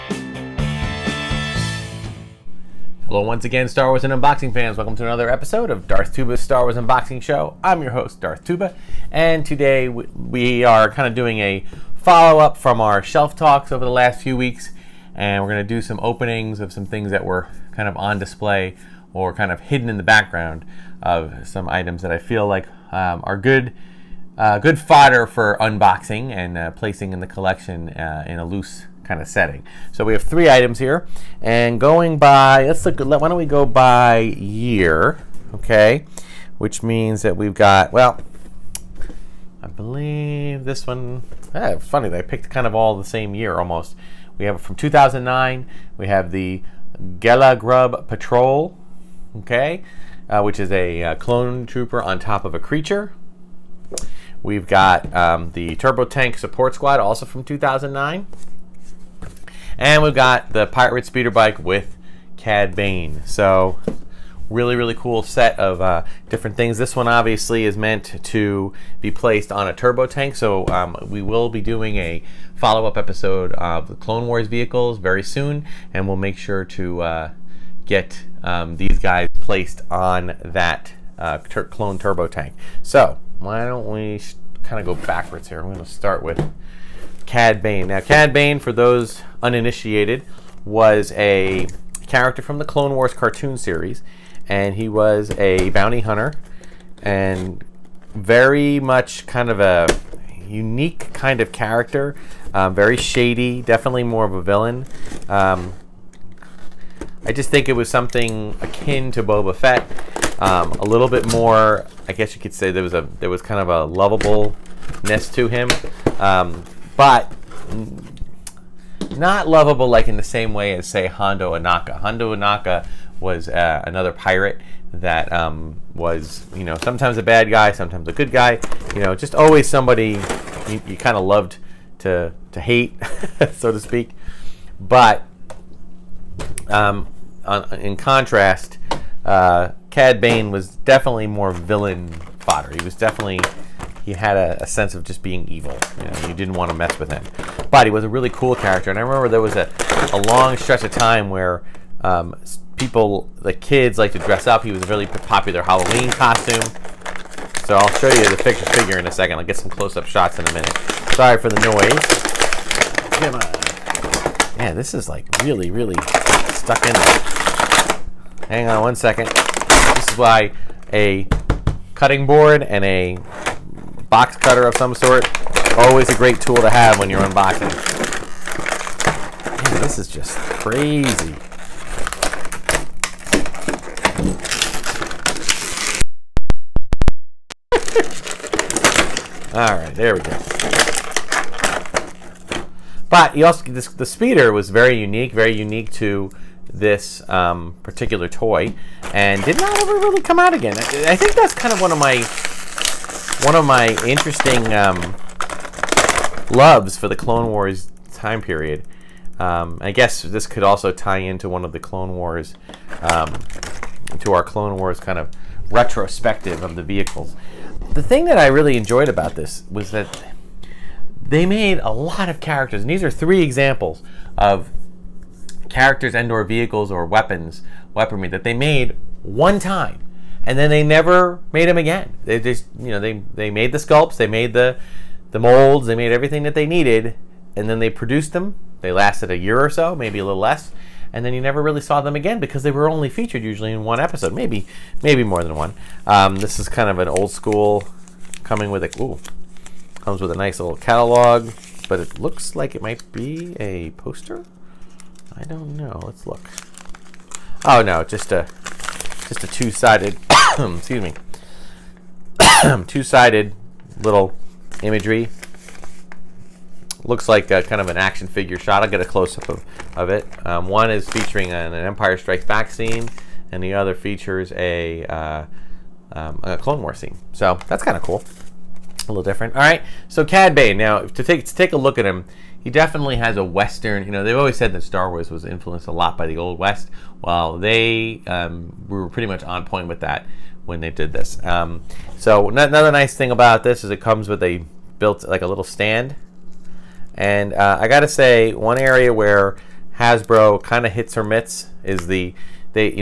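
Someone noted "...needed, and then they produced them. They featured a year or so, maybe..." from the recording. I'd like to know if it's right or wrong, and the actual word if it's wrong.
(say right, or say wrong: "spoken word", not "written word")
wrong: "lasted", not "featured".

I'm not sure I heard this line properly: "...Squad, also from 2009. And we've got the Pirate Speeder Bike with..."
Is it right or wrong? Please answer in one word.
right.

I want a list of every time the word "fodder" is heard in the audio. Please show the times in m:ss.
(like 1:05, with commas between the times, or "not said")
0:24, 2:22.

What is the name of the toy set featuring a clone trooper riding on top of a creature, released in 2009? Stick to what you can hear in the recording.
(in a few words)
Gelagrub Patrol.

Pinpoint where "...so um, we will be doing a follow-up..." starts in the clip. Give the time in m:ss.
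1:10.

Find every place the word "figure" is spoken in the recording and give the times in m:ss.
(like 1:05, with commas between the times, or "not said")
2:38, 4:28.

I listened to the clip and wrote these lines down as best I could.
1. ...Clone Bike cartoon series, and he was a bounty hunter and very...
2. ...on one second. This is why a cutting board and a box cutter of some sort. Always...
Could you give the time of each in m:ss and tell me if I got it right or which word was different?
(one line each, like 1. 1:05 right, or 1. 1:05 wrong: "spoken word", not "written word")
1. 1:32 wrong: "Wars", not "Bike"
2. 2:48 right.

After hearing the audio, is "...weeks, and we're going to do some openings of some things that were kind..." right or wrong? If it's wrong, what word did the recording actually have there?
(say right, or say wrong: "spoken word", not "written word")
right.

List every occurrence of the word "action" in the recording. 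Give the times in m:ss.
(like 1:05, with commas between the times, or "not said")
4:27.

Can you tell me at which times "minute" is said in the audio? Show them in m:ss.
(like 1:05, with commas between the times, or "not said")
2:40.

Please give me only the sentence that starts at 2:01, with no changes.
Hondo Ohnaka was uh, another pirate that um, was you know sometimes a bad guy, sometimes a good guy.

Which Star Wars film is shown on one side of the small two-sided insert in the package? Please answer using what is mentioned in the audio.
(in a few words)
Empire Strikes Back.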